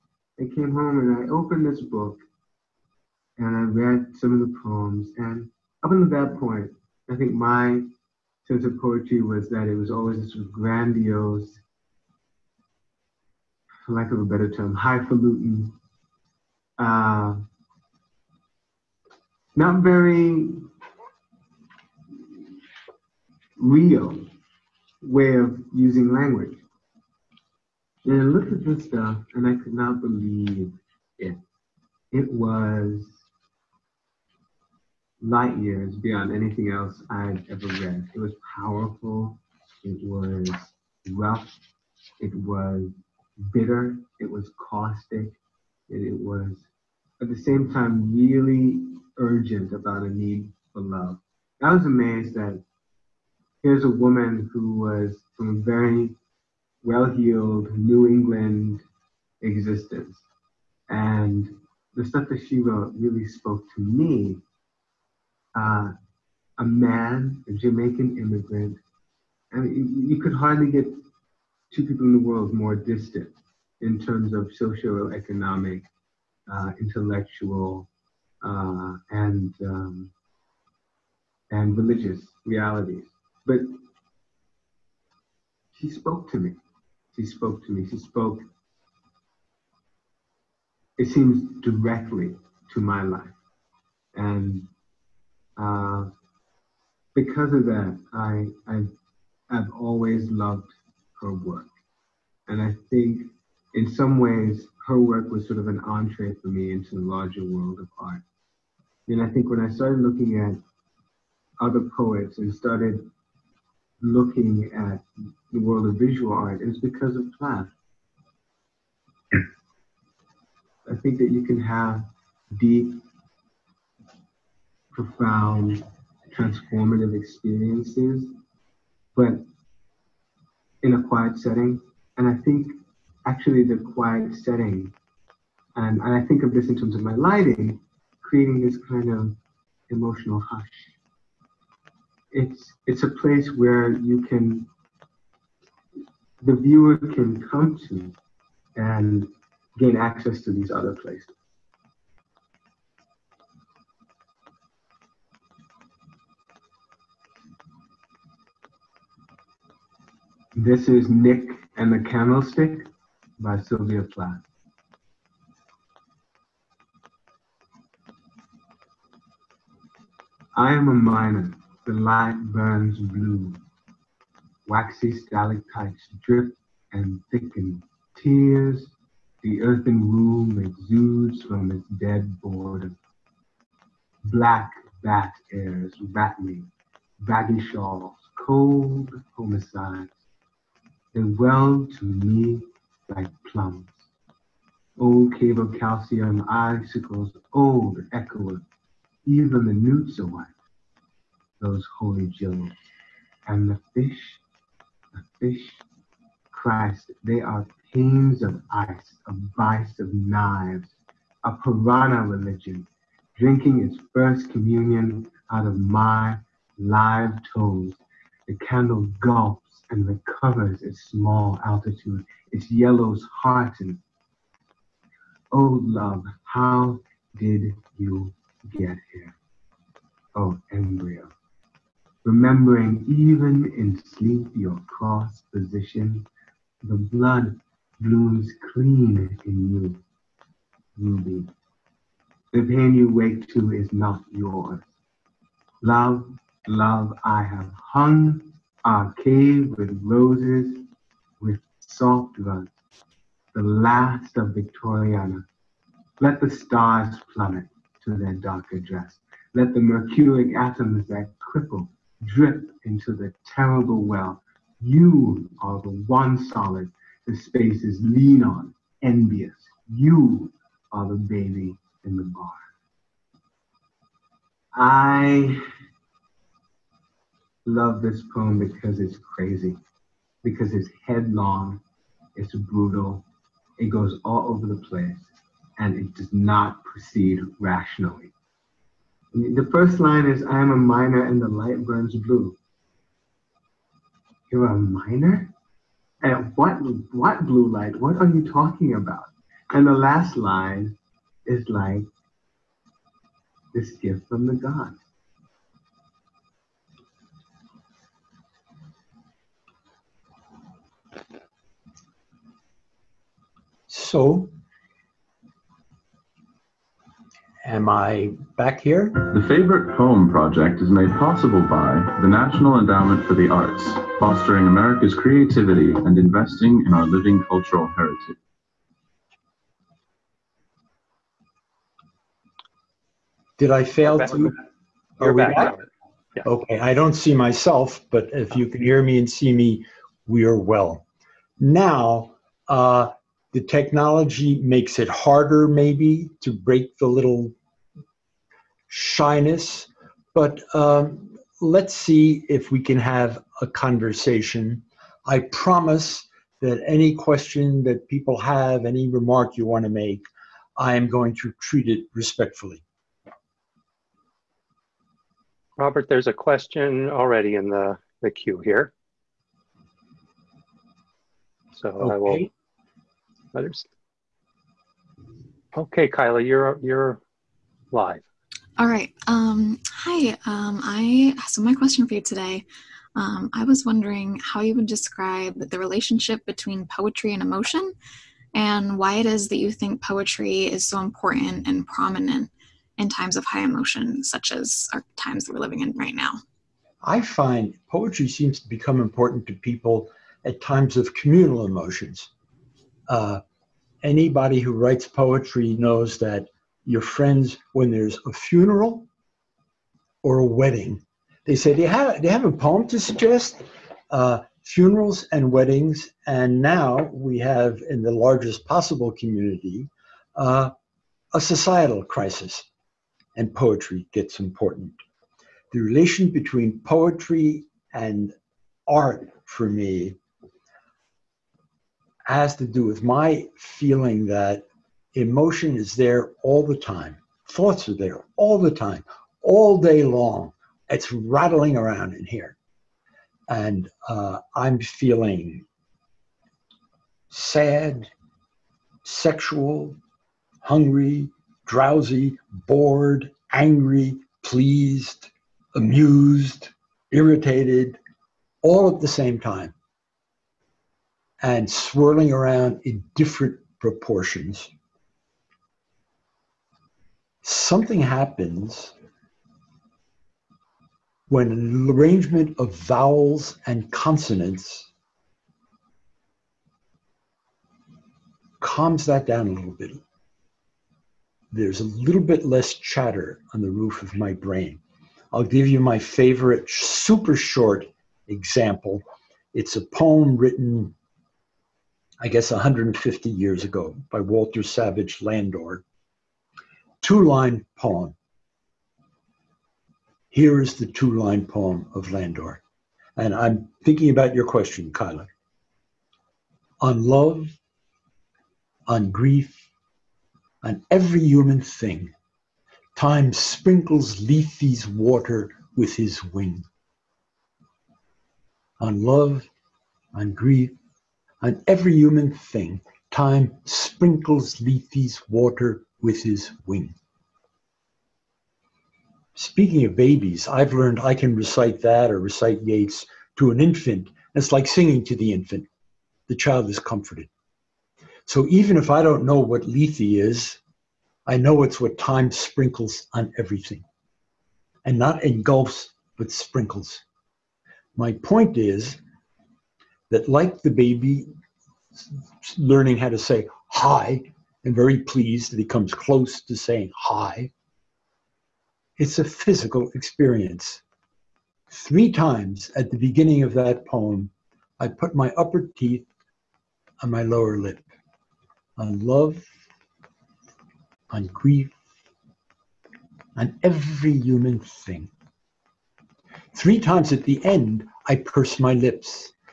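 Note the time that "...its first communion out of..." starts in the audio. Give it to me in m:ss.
3:33.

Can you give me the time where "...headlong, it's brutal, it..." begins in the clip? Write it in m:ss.
4:41.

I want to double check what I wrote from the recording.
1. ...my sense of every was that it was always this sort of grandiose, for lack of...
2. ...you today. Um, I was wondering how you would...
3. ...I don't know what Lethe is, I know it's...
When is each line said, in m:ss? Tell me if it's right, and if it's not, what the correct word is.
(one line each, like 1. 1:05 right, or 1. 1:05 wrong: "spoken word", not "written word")
1. 0:07 wrong: "poetry", not "every"
2. 6:22 right
3. 8:58 right.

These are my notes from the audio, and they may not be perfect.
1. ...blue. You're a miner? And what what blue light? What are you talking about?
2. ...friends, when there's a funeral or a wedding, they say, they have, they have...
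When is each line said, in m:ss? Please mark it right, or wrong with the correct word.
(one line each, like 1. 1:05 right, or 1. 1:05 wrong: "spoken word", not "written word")
1. 4:52 right
2. 6:47 right.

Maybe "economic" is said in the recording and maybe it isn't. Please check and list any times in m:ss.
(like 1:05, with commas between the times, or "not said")
1:14.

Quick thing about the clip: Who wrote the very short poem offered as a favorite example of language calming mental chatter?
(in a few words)
Walter Savage Landor.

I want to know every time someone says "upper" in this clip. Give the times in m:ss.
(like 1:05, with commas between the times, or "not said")
9:25.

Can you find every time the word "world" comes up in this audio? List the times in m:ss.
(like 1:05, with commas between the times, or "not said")
1:12, 1:47, 1:55.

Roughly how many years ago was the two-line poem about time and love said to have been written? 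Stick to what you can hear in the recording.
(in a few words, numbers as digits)
150.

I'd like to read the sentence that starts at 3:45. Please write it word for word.
Oh, love, how did you get here?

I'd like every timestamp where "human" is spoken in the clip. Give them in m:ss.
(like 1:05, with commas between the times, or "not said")
8:31, 8:41, 9:34.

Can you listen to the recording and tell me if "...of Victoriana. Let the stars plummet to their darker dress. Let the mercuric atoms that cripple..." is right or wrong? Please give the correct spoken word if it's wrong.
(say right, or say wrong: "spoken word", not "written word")
right.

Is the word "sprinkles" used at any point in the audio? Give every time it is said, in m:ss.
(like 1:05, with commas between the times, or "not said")
8:33, 8:43, 9:02, 9:06.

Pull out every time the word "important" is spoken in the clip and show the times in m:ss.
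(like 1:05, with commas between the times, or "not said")
6:31, 6:39, 7:04.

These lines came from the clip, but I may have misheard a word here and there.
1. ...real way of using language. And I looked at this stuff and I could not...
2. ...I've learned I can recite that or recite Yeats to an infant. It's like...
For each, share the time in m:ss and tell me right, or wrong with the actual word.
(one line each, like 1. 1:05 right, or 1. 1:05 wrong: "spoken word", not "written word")
1. 0:23 right
2. 8:50 right.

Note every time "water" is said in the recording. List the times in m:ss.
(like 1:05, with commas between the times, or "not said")
8:34, 8:45.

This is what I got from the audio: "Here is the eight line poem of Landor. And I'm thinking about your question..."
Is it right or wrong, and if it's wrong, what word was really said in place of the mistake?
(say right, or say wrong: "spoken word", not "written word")
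wrong: "two", not "eight".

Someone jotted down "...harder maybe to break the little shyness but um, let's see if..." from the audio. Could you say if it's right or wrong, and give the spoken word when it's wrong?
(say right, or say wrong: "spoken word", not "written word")
right.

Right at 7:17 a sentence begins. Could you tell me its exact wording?
Thoughts are there all the time, all day long.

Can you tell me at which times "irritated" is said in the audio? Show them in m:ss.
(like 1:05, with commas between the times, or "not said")
7:37.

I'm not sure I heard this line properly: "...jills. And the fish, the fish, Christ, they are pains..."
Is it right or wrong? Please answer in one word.
right.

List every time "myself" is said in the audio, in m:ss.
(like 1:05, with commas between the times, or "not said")
5:37.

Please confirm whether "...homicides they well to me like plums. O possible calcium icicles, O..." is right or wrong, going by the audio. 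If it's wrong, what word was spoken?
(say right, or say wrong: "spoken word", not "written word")
wrong: "cable", not "possible".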